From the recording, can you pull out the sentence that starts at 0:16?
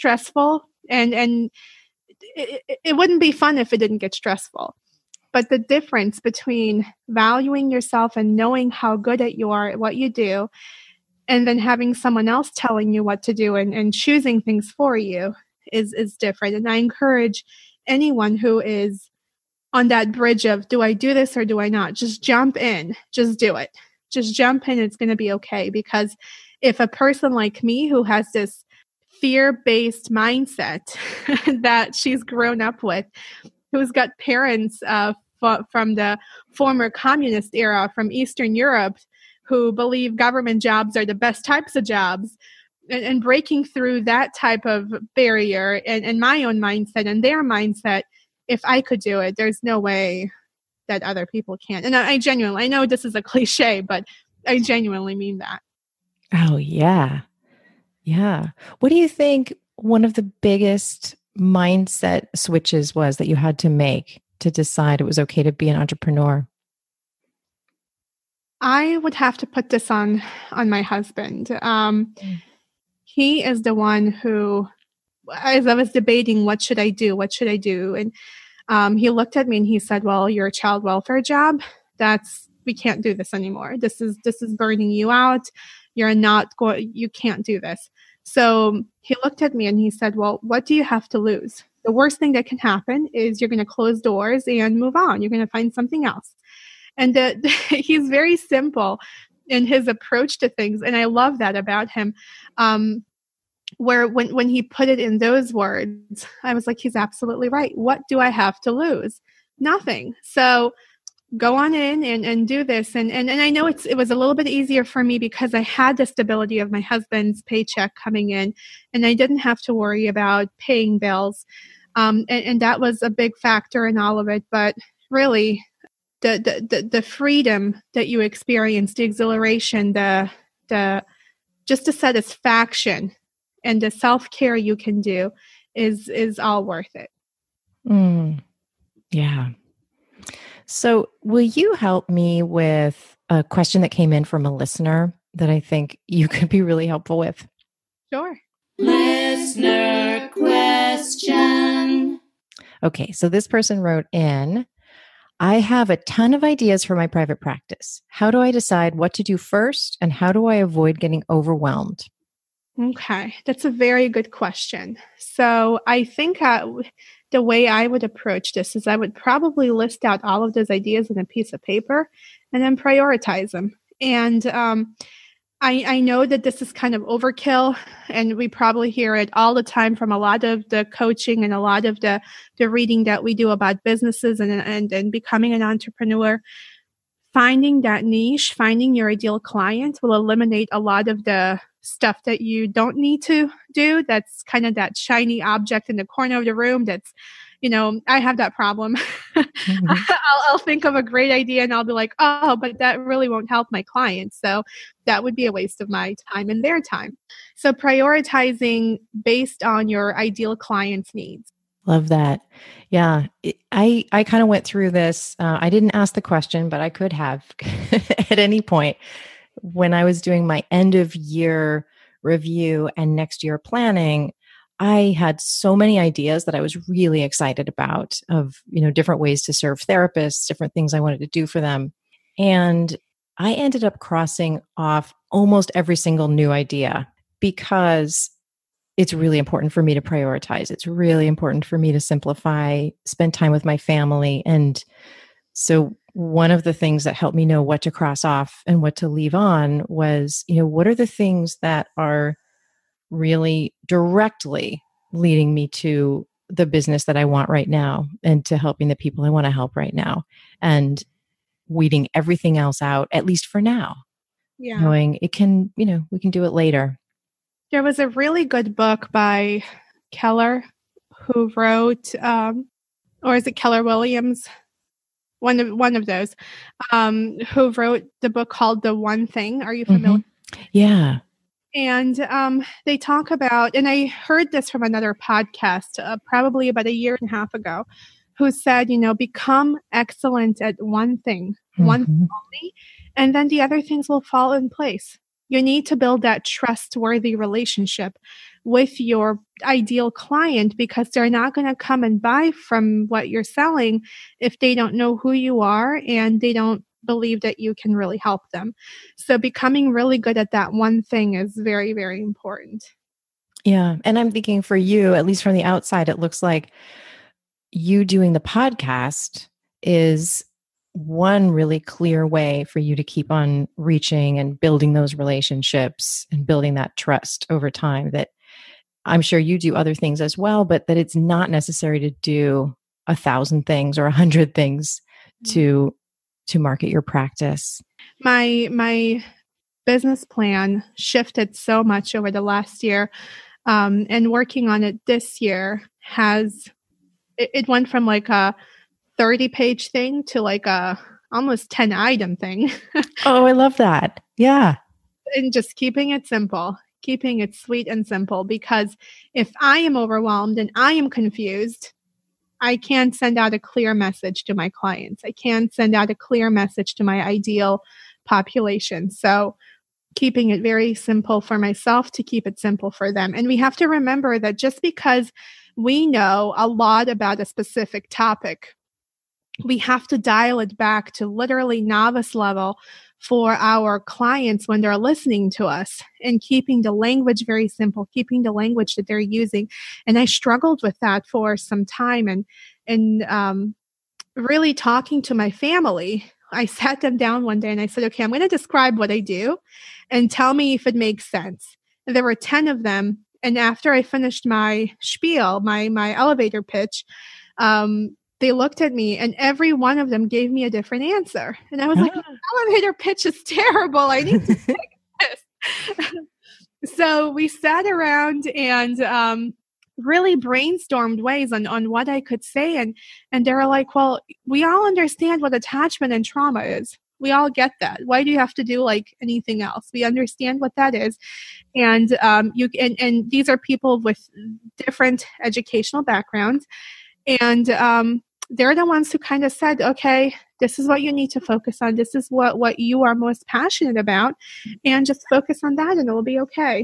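And I encourage anyone who is on that bridge of do I do this or do I not?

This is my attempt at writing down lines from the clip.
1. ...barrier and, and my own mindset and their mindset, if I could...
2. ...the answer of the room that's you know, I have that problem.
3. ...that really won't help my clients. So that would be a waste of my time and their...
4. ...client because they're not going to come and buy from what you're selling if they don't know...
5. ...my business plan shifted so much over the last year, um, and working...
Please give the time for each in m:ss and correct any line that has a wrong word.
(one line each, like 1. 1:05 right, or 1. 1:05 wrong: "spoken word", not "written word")
1. 0:45 right
2. 3:15 wrong: "corner", not "answer"
3. 3:22 right
4. 5:00 right
5. 5:38 right.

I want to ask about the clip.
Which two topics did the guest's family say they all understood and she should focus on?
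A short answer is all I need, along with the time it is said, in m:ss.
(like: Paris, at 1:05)
Attachment and trauma, at 7:05.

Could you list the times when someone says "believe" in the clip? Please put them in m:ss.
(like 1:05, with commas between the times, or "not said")
0:39, 5:07.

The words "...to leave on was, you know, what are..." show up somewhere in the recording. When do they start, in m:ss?
4:08.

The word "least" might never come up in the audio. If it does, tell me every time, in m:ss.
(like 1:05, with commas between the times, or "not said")
4:23, 5:15.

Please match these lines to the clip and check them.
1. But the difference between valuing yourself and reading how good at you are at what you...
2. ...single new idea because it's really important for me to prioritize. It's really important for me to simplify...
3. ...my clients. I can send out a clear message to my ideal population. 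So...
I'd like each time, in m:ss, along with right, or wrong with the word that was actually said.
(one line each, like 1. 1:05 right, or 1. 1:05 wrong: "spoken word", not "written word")
1. 0:05 wrong: "knowing", not "reading"
2. 3:55 right
3. 6:04 right.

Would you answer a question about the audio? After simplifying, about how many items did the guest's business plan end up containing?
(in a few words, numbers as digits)
10.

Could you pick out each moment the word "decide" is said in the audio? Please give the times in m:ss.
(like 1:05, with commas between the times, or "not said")
1:04, 2:38.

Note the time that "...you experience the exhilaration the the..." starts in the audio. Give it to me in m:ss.
2:08.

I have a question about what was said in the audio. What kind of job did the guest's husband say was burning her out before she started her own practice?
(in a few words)
Child welfare job.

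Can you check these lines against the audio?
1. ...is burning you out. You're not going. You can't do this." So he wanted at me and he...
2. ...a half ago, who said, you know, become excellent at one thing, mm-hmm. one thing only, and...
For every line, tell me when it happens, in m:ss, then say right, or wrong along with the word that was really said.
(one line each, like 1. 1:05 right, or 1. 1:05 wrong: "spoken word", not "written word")
1. 1:24 wrong: "looked", not "wanted"
2. 4:47 right.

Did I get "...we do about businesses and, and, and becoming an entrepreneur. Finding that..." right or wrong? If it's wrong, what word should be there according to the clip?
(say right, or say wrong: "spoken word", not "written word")
right.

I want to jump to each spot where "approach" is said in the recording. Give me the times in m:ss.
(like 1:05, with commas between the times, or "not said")
1:39, 2:48.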